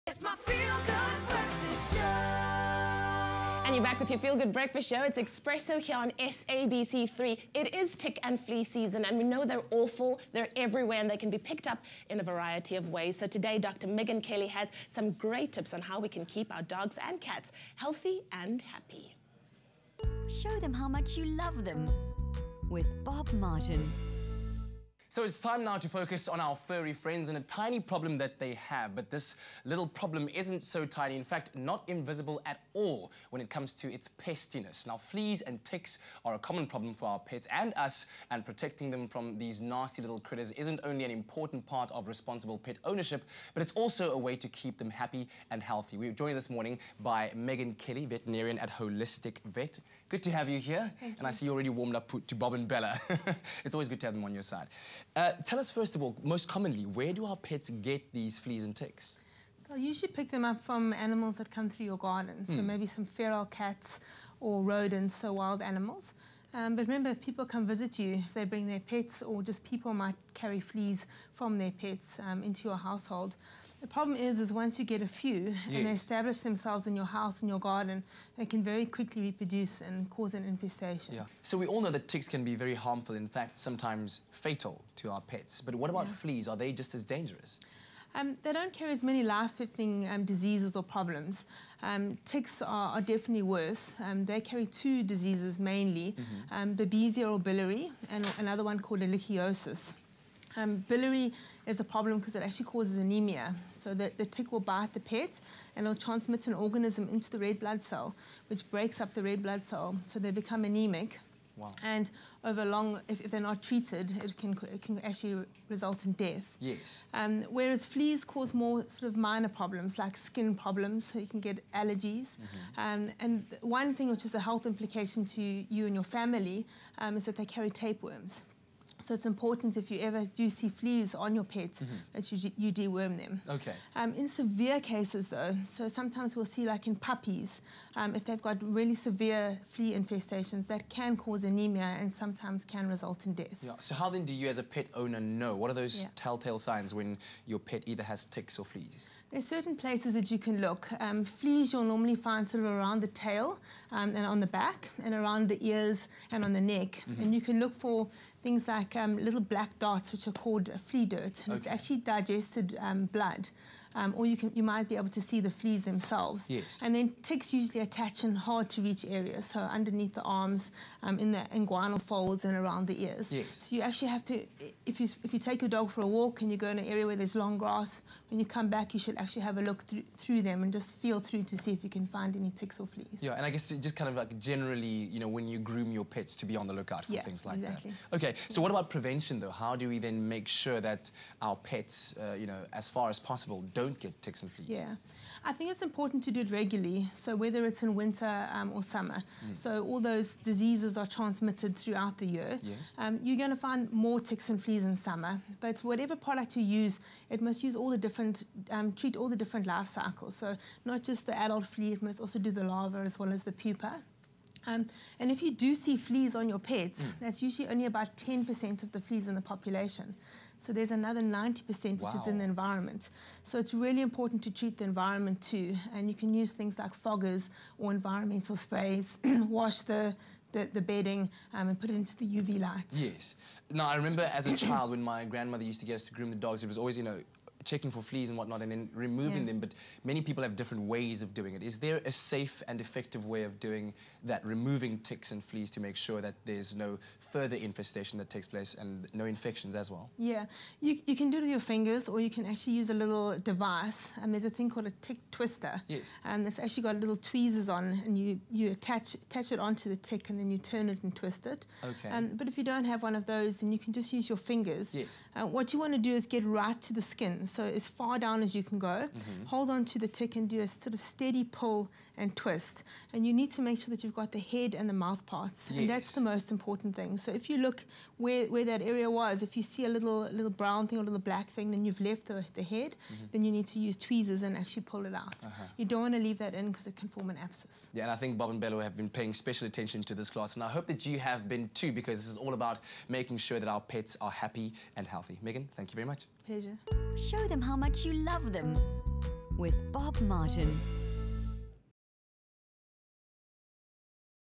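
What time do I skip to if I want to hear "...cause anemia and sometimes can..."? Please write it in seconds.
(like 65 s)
141 s.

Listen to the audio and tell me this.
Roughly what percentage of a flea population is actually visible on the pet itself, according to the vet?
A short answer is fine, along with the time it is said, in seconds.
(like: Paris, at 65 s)
10%, at 218 s.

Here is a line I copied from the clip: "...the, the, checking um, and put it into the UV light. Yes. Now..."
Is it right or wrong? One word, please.
wrong.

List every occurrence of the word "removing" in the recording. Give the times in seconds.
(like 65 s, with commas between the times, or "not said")
238 s, 244 s.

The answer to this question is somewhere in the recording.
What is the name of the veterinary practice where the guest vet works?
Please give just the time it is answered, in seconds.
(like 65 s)
48 s.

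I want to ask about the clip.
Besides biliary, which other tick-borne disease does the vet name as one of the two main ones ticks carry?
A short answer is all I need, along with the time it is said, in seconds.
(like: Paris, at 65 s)
ehrlichiosis, at 99 s.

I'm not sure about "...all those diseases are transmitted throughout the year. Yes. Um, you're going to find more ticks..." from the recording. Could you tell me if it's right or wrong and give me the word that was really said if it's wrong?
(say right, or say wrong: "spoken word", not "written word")
right.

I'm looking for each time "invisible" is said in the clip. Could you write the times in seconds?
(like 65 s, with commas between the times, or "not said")
31 s.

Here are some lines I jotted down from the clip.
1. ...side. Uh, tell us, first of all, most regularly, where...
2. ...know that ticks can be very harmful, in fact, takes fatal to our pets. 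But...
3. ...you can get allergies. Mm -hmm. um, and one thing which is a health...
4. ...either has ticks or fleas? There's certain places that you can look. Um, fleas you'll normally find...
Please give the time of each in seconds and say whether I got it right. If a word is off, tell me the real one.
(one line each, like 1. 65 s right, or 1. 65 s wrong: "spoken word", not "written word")
1. 54 s wrong: "commonly", not "regularly"
2. 81 s wrong: "sometimes", not "takes"
3. 121 s right
4. 147 s right.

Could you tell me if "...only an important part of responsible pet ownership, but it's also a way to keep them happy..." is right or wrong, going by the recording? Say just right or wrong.
right.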